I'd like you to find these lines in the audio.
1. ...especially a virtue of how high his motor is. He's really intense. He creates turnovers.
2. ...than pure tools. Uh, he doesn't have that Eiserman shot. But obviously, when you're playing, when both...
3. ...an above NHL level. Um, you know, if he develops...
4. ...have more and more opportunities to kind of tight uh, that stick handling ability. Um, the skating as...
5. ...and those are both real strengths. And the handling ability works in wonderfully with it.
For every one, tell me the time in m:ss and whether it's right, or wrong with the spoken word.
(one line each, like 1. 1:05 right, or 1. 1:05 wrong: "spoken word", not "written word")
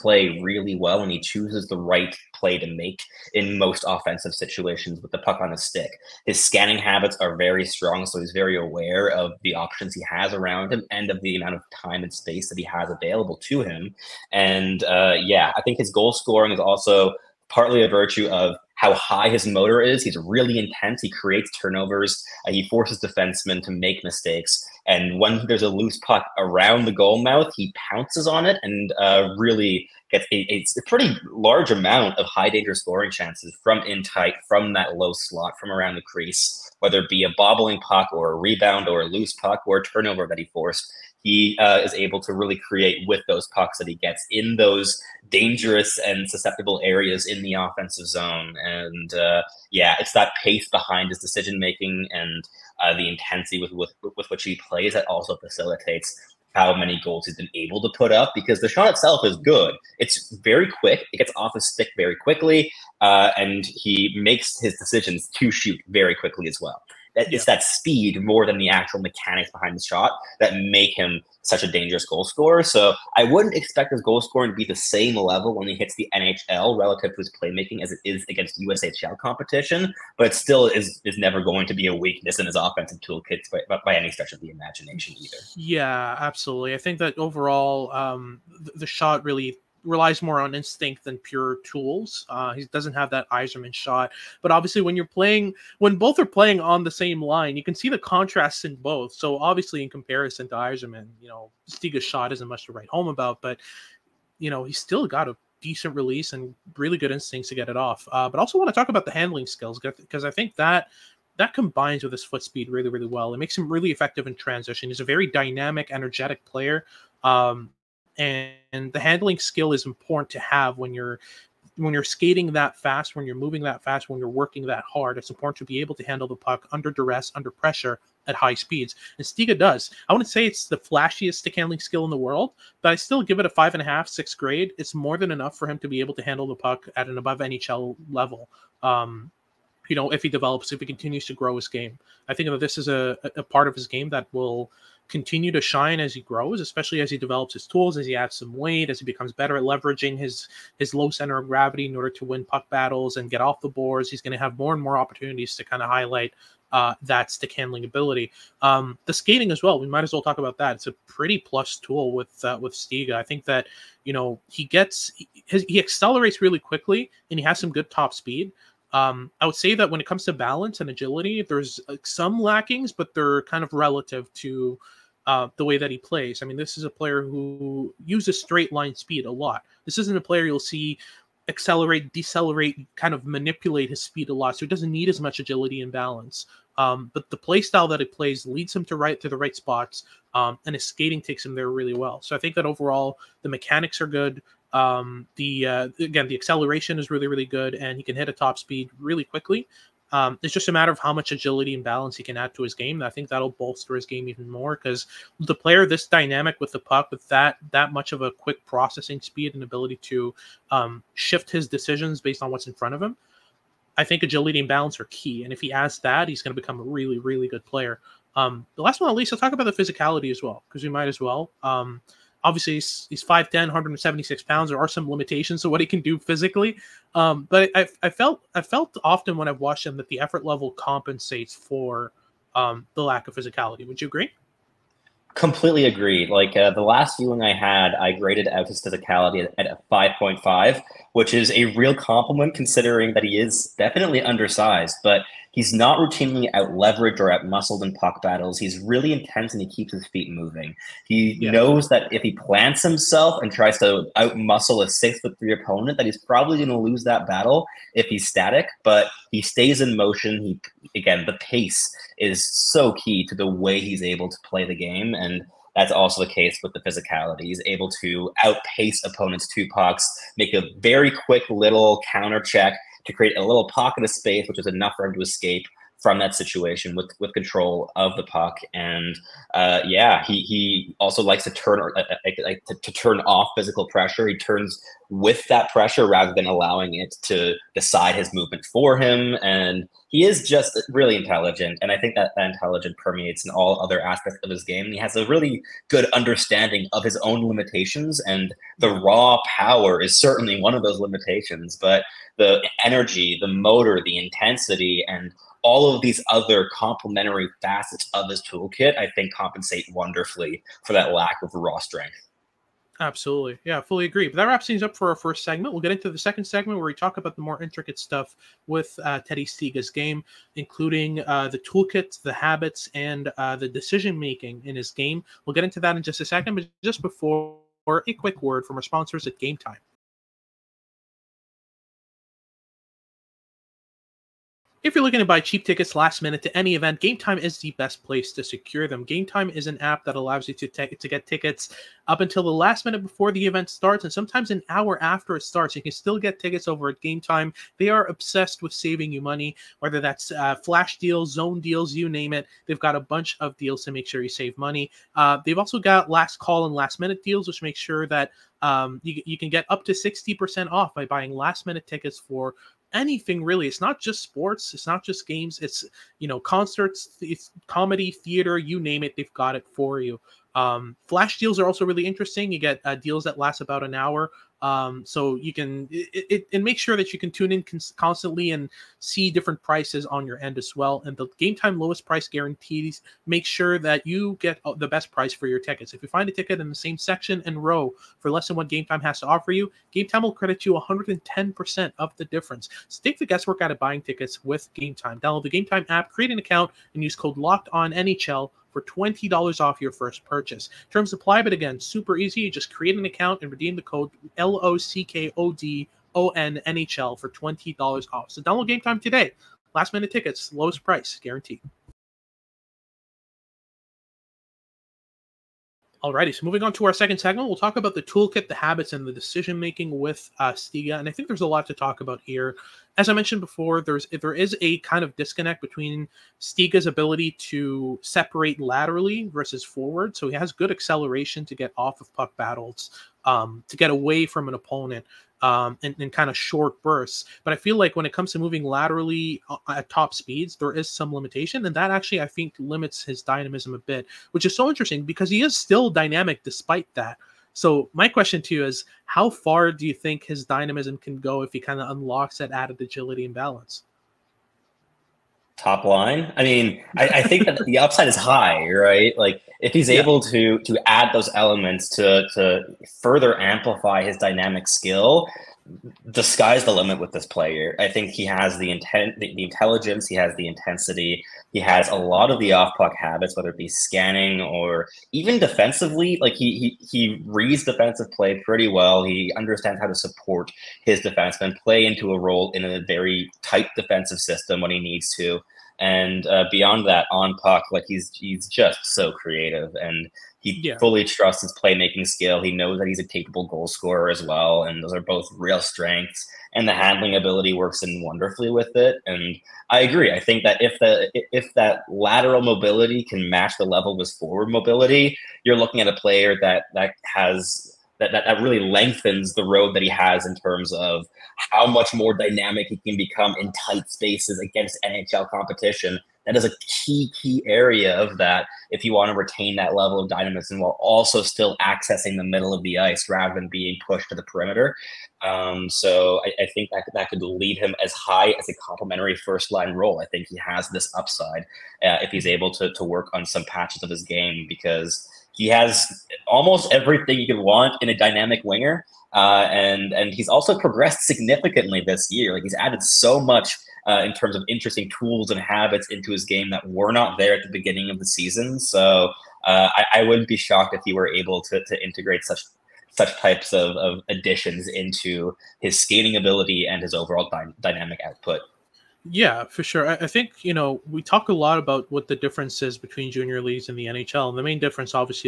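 1. 0:17 wrong: "partly", not "especially"
2. 1:31 right
3. 2:17 right
4. 2:34 wrong: "highlight", not "tight"
5. 8:14 right.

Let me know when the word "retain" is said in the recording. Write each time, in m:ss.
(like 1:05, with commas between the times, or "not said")
8:39.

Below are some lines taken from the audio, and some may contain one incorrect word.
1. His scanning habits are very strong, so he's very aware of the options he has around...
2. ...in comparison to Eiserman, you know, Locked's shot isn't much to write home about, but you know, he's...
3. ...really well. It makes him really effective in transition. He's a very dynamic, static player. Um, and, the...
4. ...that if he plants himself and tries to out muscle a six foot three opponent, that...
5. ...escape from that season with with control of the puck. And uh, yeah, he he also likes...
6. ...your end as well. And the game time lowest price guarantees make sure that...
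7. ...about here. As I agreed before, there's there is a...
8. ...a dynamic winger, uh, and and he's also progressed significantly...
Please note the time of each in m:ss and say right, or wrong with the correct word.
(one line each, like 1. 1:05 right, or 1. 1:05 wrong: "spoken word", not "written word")
1. 0:06 right
2. 1:39 wrong: "Stiga", not "Locked"
3. 1:52 wrong: "energetic", not "static"
4. 4:11 right
5. 4:35 wrong: "situation", not "season"
6. 6:20 right
7. 7:02 wrong: "mentioned", not "agreed"
8. 8:57 right.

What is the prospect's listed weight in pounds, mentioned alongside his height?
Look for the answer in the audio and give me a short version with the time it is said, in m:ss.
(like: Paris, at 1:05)
176, at 3:43.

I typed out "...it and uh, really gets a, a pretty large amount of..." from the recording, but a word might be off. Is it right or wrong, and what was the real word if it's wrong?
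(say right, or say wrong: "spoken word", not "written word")
right.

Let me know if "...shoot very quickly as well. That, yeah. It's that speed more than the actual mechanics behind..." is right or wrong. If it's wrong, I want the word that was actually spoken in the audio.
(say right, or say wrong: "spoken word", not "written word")
right.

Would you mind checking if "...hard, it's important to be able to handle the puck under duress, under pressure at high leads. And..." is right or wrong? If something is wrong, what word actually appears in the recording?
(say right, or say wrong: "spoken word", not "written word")
wrong: "speeds", not "leads".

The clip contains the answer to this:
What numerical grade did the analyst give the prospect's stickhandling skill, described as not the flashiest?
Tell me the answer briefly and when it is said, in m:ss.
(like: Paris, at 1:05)
5.5, at 2:13.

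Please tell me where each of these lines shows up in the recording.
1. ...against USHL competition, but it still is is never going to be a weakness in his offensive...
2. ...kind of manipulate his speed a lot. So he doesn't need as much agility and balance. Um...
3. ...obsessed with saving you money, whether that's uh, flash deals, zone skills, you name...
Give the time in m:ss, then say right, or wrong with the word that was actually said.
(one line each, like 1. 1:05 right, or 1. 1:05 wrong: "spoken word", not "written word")
1. 1:18 right
2. 3:02 right
3. 5:48 wrong: "deals", not "skills".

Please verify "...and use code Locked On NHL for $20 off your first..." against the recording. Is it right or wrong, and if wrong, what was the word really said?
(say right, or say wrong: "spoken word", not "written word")
right.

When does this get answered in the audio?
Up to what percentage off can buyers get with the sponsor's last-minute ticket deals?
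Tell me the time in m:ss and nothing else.
5:59.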